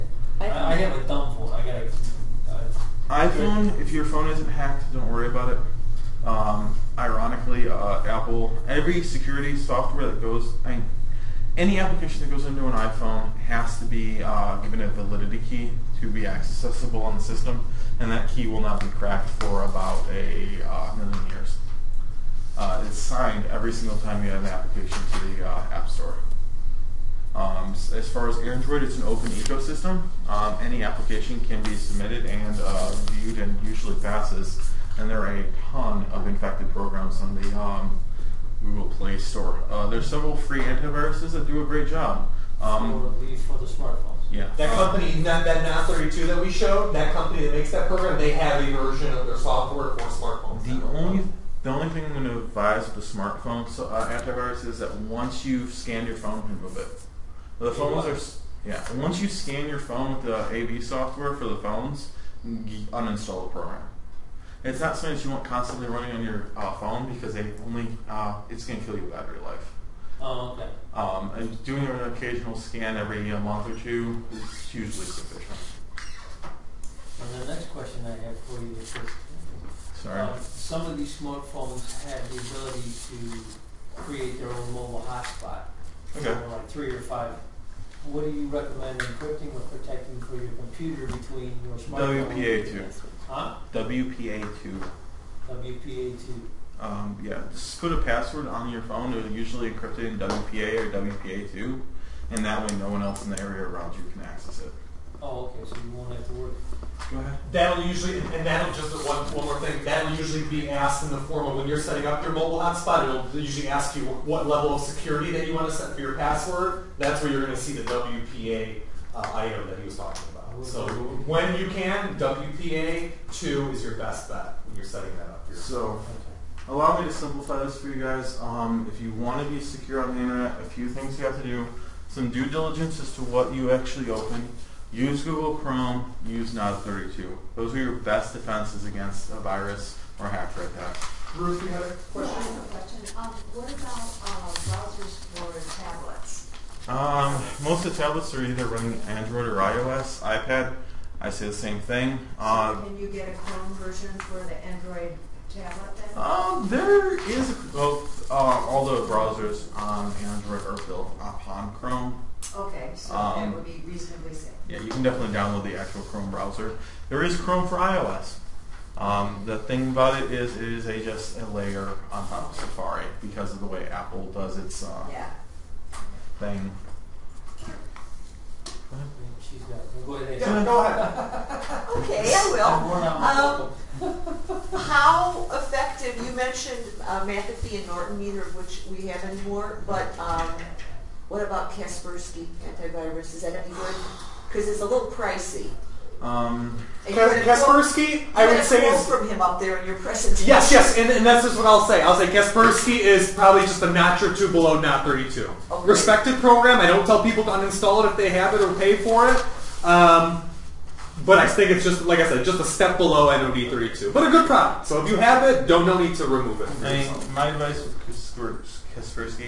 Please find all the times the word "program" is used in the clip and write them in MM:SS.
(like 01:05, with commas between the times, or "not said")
00:36, 00:47, 01:03, 03:26.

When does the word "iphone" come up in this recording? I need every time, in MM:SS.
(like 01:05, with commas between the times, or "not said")
00:03, 00:12.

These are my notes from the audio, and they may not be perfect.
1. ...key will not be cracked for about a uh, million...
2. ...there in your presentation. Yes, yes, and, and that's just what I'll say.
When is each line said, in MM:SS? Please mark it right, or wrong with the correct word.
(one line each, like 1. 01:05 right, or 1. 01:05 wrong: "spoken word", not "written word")
1. 00:18 right
2. 03:19 right.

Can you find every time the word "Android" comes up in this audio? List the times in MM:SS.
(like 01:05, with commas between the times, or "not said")
00:28, 02:29, 02:34, 02:40.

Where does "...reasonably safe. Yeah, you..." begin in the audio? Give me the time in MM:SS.
02:43.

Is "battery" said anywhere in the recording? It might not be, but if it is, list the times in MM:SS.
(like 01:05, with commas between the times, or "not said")
01:09.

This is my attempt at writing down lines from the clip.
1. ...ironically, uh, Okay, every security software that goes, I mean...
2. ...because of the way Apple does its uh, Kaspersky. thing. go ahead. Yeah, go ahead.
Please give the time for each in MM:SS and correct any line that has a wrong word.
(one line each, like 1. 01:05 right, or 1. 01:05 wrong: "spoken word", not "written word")
1. 00:06 wrong: "Apple", not "Okay"
2. 02:53 wrong: "Yeah", not "Kaspersky".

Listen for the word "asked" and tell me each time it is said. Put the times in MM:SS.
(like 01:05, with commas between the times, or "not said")
01:50.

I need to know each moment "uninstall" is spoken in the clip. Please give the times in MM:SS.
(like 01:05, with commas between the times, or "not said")
01:02, 03:27.